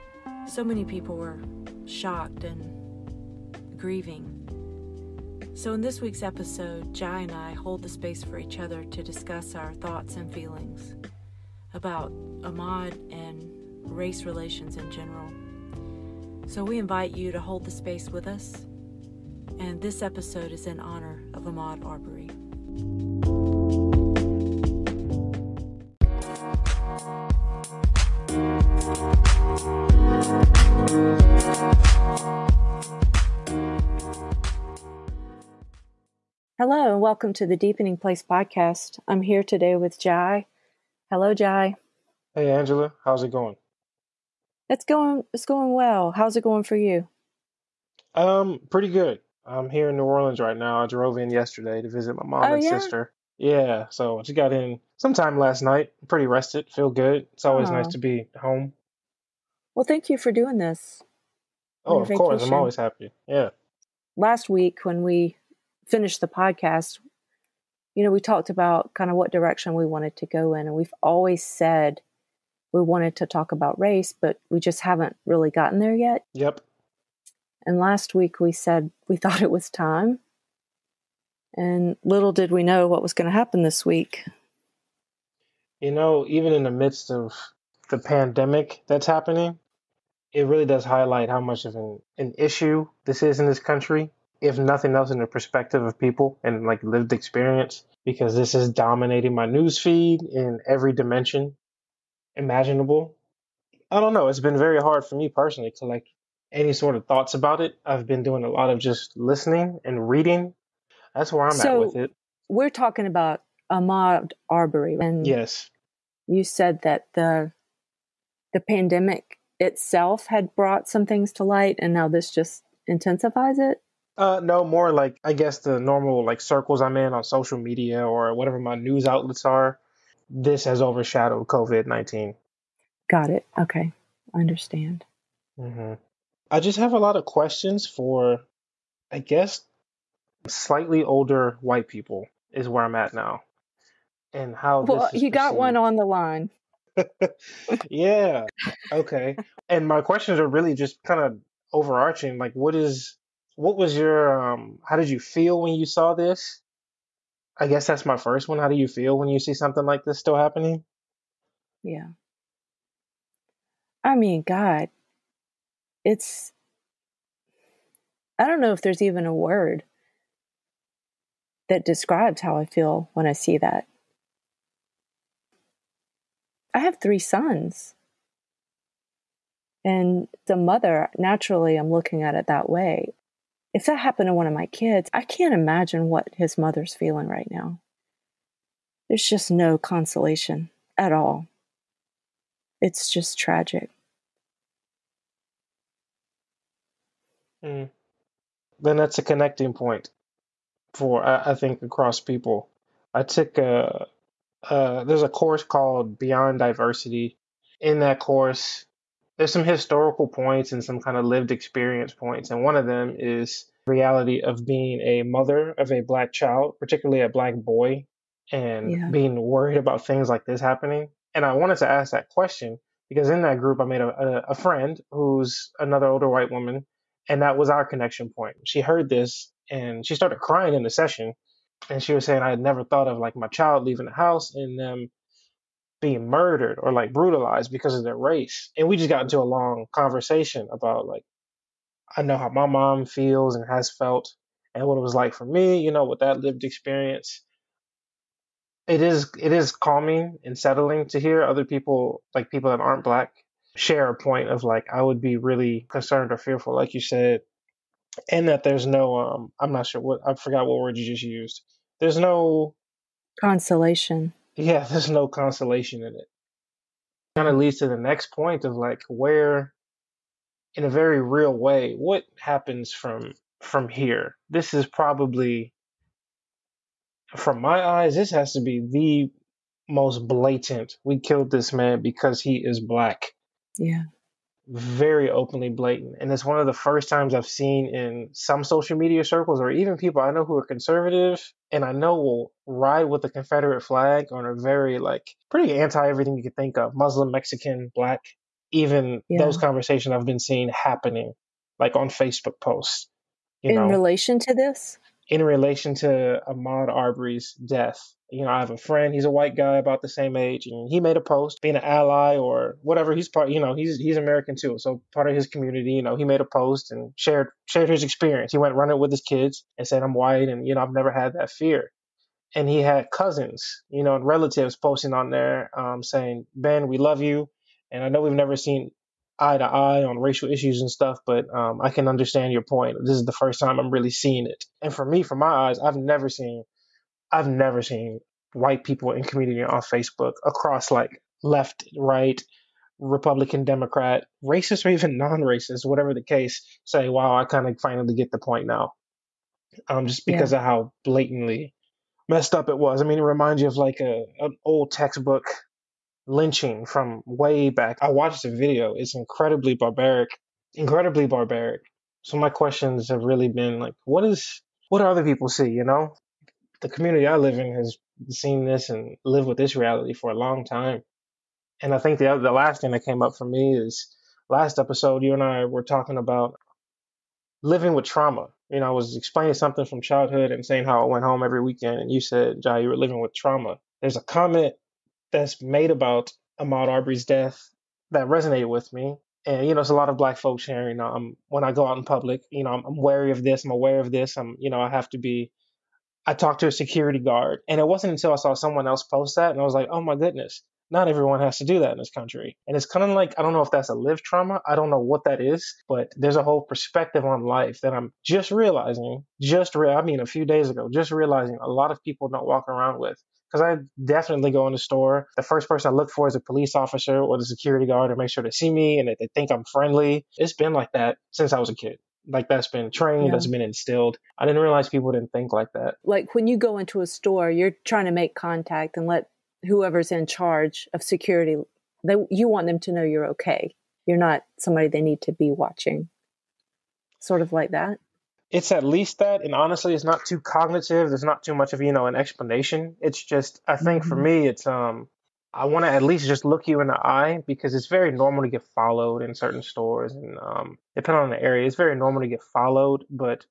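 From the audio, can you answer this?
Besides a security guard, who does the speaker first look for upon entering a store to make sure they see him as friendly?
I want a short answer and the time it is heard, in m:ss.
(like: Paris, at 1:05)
police officer, at 6:56.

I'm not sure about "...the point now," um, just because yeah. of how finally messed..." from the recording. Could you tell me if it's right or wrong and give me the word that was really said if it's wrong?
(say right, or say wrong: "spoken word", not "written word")
wrong: "blatantly", not "finally".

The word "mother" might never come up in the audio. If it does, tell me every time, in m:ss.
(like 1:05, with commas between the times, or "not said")
3:00, 3:06, 3:35.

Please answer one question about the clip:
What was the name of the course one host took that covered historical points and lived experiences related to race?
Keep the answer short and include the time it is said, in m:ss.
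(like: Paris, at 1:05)
Beyond Diversity, at 3:26.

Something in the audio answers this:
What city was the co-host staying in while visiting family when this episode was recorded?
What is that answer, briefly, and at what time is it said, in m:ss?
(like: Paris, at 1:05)
New Orleans, at 0:49.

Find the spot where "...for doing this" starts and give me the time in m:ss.
1:00.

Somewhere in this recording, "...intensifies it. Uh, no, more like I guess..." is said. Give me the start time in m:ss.
2:02.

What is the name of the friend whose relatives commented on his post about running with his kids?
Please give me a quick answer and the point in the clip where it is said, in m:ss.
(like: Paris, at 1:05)
Ben, at 5:26.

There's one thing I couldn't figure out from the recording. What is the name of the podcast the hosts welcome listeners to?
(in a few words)
Deepening Place.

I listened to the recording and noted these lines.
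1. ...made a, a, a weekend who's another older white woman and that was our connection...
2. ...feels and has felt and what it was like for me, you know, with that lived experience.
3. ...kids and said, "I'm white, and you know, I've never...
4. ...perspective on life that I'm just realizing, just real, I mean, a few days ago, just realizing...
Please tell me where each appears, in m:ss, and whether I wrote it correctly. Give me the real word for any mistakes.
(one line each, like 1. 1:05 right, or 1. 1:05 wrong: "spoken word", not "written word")
1. 3:43 wrong: "friend", not "weekend"
2. 4:03 right
3. 5:19 right
4. 6:46 right.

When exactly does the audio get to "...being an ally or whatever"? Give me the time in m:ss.
5:11.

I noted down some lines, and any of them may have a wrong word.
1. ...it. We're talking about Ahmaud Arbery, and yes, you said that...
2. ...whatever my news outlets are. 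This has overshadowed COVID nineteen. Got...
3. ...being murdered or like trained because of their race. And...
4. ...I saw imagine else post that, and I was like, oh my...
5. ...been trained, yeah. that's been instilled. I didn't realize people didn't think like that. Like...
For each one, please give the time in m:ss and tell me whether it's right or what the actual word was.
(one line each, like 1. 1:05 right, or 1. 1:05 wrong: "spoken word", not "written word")
1. 1:51 right
2. 2:08 right
3. 3:56 wrong: "brutalized", not "trained"
4. 6:38 wrong: "someone", not "imagine"
5. 7:02 right.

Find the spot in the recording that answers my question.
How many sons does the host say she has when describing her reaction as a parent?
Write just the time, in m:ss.
2:56.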